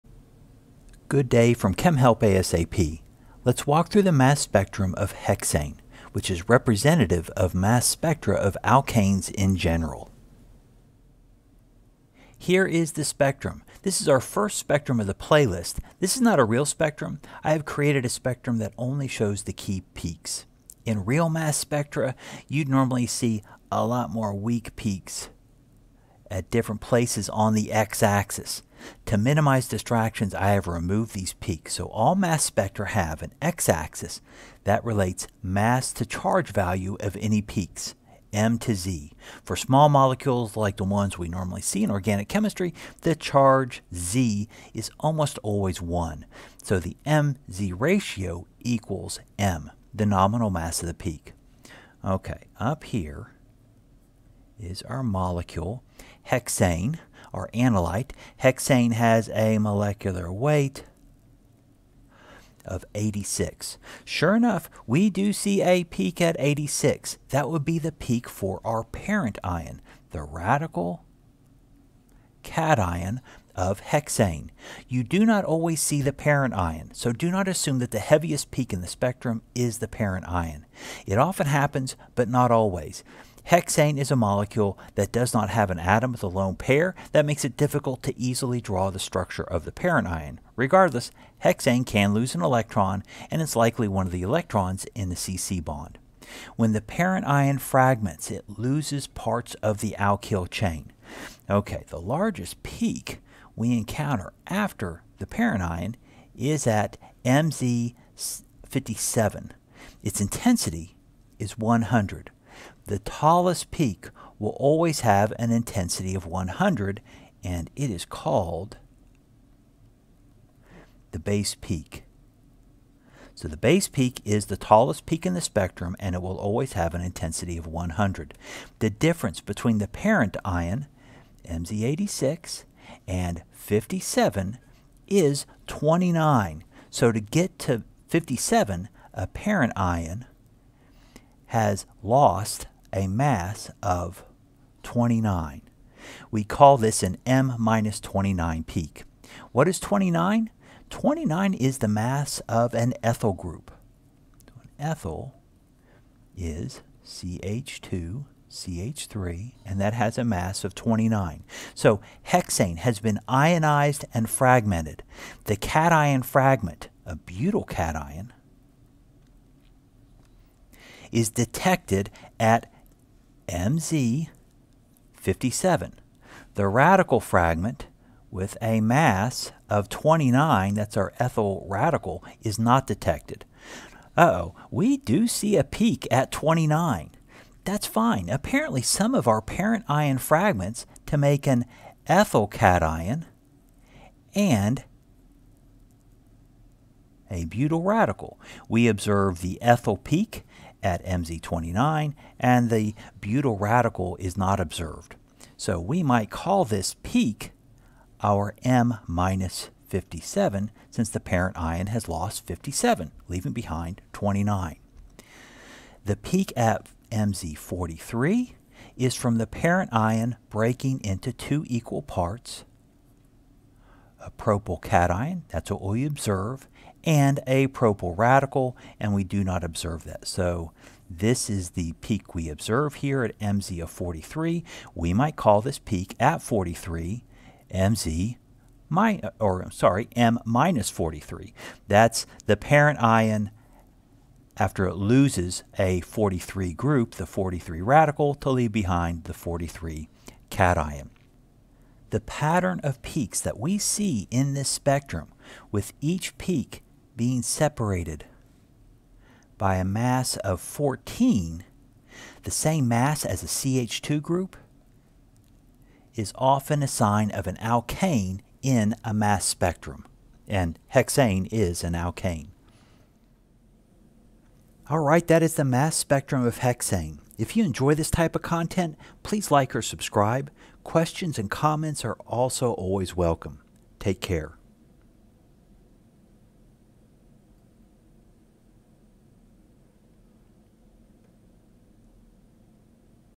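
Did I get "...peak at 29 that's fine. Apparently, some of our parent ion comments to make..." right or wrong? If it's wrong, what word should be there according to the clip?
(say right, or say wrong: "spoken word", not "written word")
wrong: "fragments", not "comments".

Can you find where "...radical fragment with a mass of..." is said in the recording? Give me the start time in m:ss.
2:56.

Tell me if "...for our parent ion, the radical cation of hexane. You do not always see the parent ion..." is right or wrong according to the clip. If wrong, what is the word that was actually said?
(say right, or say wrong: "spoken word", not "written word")
right.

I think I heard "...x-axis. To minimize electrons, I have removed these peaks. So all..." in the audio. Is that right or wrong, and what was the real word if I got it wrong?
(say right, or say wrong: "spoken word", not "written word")
wrong: "distractions", not "electrons".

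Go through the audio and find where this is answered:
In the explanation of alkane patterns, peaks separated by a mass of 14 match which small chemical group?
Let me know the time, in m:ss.
4:23.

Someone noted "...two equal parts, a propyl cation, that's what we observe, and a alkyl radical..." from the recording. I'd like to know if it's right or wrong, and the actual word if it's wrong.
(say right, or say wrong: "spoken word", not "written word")
wrong: "propyl", not "alkyl".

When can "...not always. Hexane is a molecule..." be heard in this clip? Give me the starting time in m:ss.
1:22.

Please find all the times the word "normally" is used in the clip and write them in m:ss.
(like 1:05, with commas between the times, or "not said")
0:22, 0:41.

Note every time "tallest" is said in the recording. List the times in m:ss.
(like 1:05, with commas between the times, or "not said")
1:52, 2:04.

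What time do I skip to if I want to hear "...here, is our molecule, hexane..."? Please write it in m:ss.
0:52.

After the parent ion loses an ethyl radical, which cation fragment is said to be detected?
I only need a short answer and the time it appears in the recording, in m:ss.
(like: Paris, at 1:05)
butyl cation, at 2:47.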